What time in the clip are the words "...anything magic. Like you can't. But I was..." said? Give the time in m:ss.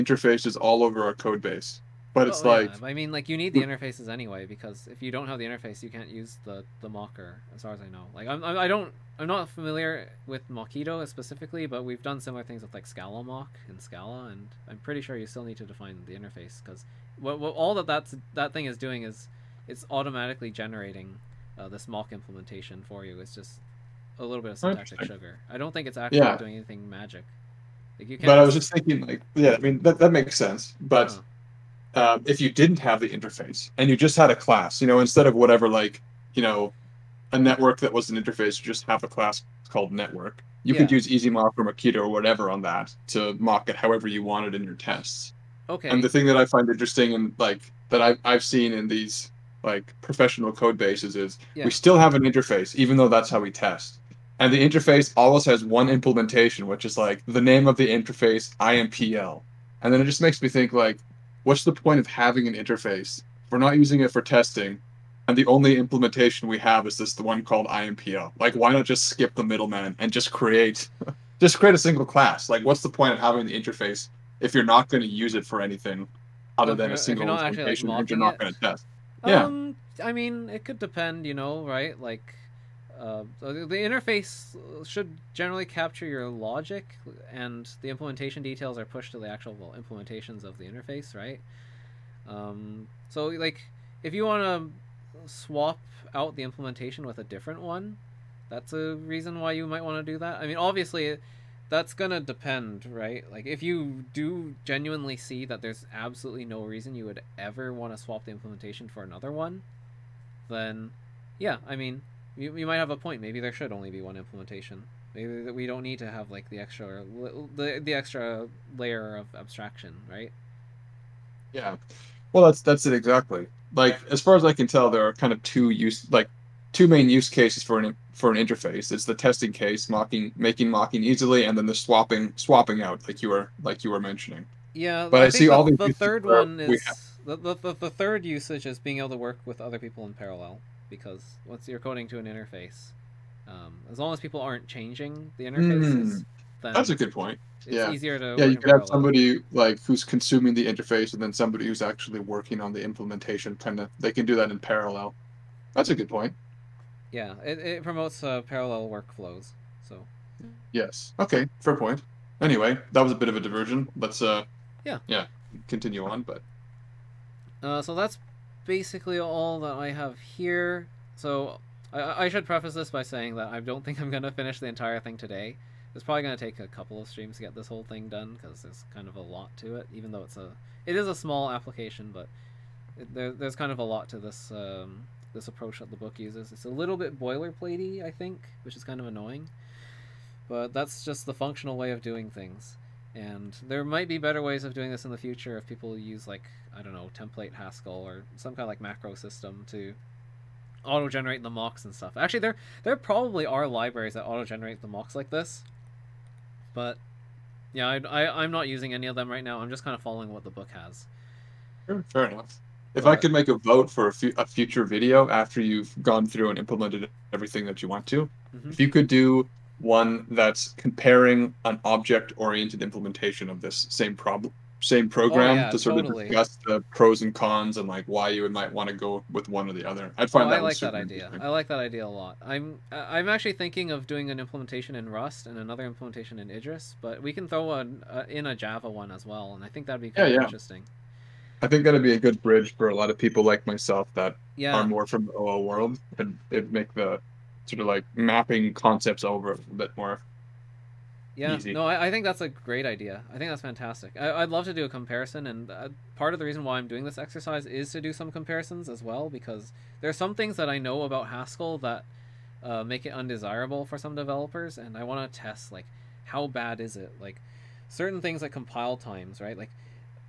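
0:26.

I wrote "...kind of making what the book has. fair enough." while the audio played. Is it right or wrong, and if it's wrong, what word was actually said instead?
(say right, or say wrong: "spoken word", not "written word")
wrong: "following", not "making".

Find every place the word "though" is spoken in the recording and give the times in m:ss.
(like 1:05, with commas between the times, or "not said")
0:52, 3:00.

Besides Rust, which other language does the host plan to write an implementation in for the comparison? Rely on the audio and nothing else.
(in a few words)
Idris.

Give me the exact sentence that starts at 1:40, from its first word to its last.
I mean, obviously, that's gonna depend, right?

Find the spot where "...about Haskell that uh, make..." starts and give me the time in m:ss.
4:21.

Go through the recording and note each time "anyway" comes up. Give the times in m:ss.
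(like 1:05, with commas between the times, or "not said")
0:04, 2:42.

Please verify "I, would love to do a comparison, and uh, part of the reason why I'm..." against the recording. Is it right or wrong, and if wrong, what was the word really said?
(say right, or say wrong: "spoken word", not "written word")
right.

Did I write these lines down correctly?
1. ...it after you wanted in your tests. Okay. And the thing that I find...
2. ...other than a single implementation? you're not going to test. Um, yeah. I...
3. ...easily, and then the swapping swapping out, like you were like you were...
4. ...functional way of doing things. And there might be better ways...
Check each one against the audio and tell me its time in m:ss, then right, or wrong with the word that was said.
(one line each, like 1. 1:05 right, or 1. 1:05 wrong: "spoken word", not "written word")
1. 0:43 wrong: "however", not "after"
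2. 1:16 right
3. 2:11 right
4. 3:11 right.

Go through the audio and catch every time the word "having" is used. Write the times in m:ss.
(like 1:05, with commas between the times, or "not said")
1:02, 1:13.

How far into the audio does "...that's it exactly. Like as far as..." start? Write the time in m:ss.
2:02.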